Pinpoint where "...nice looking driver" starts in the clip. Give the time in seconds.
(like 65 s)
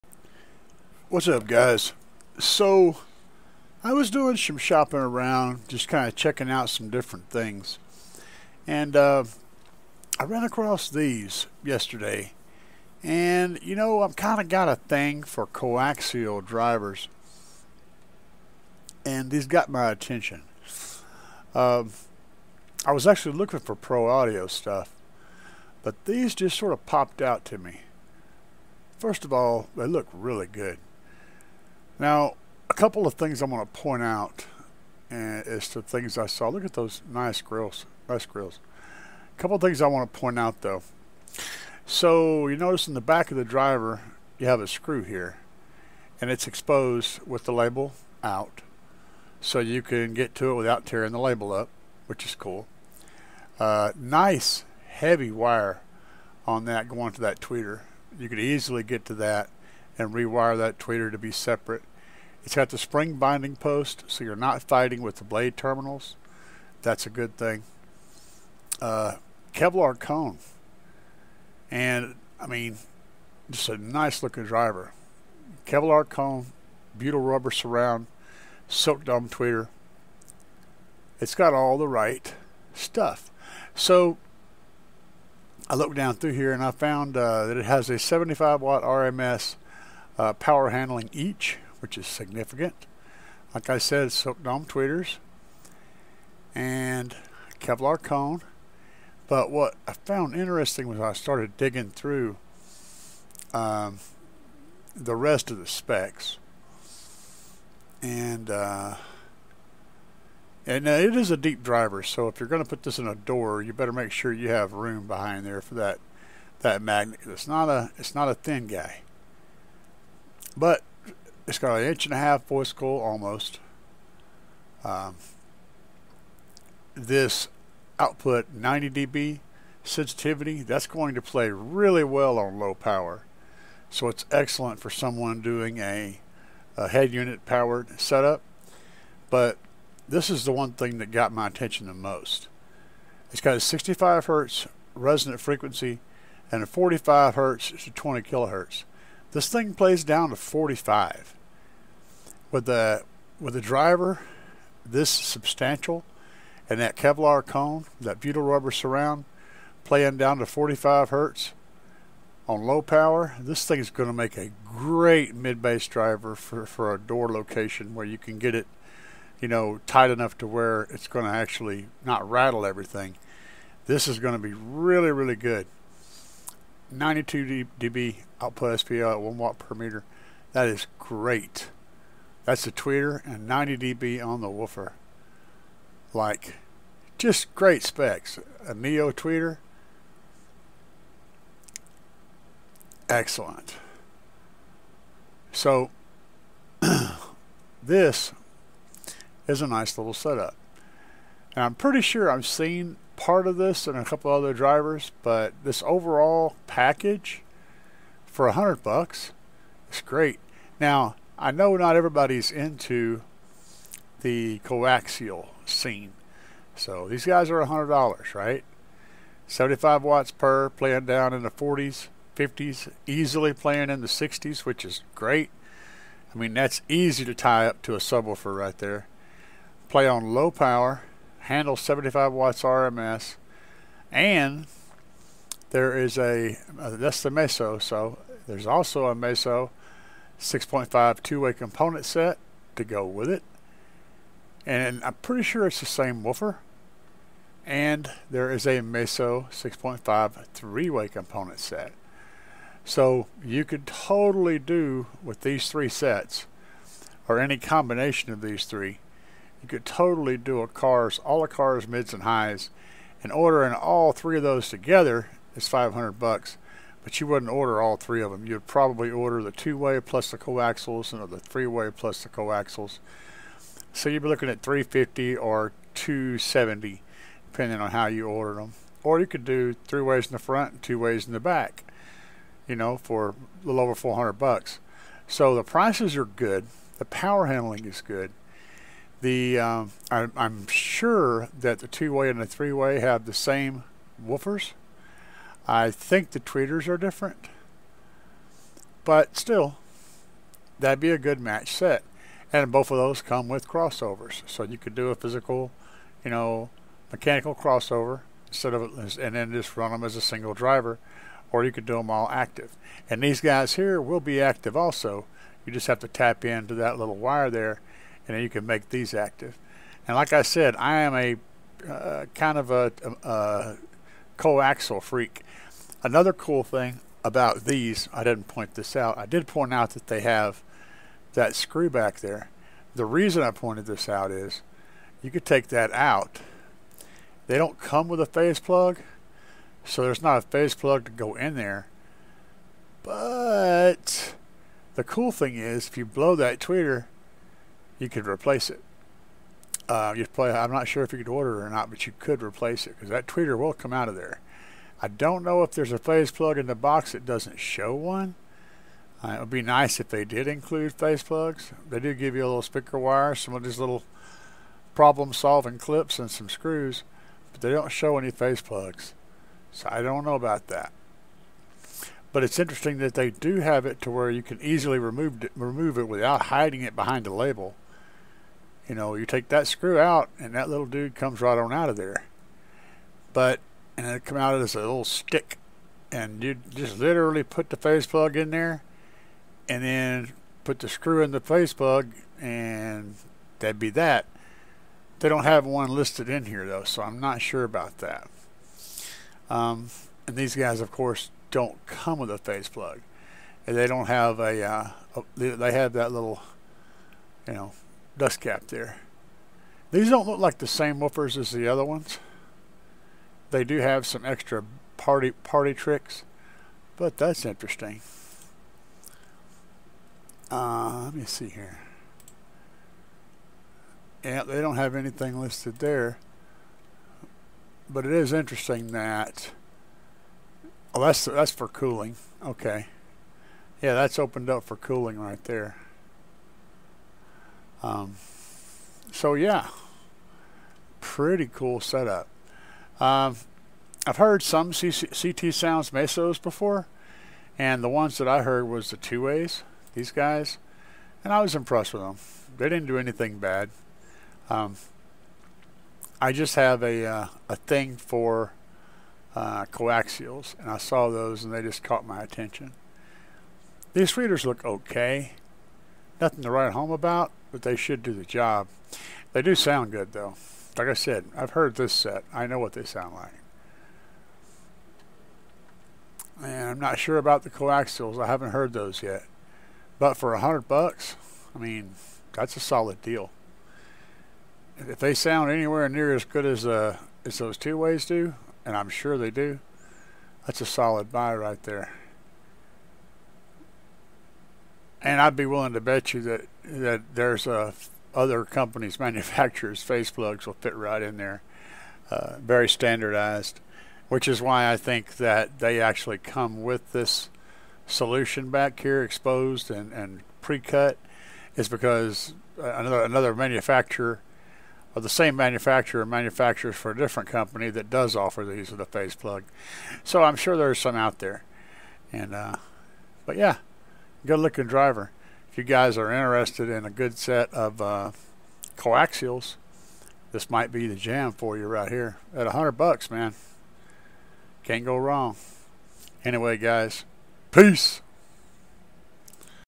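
73 s.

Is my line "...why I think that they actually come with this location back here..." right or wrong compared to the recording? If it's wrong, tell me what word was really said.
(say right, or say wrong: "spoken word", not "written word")
wrong: "solution", not "location".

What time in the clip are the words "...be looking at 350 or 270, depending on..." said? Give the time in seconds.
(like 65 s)
274 s.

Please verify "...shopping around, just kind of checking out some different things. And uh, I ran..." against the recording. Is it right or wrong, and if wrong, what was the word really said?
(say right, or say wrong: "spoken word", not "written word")
right.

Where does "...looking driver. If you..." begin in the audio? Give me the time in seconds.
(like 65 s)
524 s.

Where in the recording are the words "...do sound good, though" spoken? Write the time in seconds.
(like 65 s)
469 s.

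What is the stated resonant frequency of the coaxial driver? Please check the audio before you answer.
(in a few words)
65 Hz.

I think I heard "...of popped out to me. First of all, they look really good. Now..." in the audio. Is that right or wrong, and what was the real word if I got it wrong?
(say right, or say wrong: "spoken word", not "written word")
right.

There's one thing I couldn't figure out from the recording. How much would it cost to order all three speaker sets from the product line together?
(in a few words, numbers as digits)
$500.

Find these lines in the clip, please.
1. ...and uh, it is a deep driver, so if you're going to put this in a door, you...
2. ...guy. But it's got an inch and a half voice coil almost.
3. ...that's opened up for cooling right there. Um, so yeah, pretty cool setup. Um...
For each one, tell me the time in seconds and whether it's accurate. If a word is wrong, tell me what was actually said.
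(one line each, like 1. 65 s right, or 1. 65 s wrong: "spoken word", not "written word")
1. 110 s right
2. 118 s right
3. 433 s right.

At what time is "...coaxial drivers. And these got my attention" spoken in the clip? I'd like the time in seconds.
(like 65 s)
15 s.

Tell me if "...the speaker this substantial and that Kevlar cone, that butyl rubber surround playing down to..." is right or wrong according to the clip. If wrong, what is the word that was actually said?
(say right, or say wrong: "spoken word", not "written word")
wrong: "driver", not "speaker".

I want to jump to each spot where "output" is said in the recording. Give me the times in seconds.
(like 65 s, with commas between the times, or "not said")
127 s, 178 s.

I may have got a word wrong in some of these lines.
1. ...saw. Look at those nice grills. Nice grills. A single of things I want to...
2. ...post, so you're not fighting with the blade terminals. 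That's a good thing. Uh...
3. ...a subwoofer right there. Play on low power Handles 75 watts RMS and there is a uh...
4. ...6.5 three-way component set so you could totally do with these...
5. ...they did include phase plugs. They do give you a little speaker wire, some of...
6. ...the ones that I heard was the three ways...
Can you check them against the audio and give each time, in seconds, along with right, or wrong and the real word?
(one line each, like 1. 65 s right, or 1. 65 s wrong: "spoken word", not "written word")
1. 36 s wrong: "couple", not "single"
2. 63 s right
3. 227 s right
4. 249 s right
5. 360 s right
6. 447 s wrong: "two", not "three".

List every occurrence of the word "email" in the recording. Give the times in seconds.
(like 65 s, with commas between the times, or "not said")
not said.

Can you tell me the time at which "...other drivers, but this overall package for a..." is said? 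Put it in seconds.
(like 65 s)
204 s.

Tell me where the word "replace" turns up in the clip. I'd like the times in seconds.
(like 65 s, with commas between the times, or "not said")
348 s, 352 s.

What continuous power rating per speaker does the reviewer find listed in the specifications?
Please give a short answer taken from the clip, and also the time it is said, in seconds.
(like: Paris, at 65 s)
75 watts RMS, at 87 s.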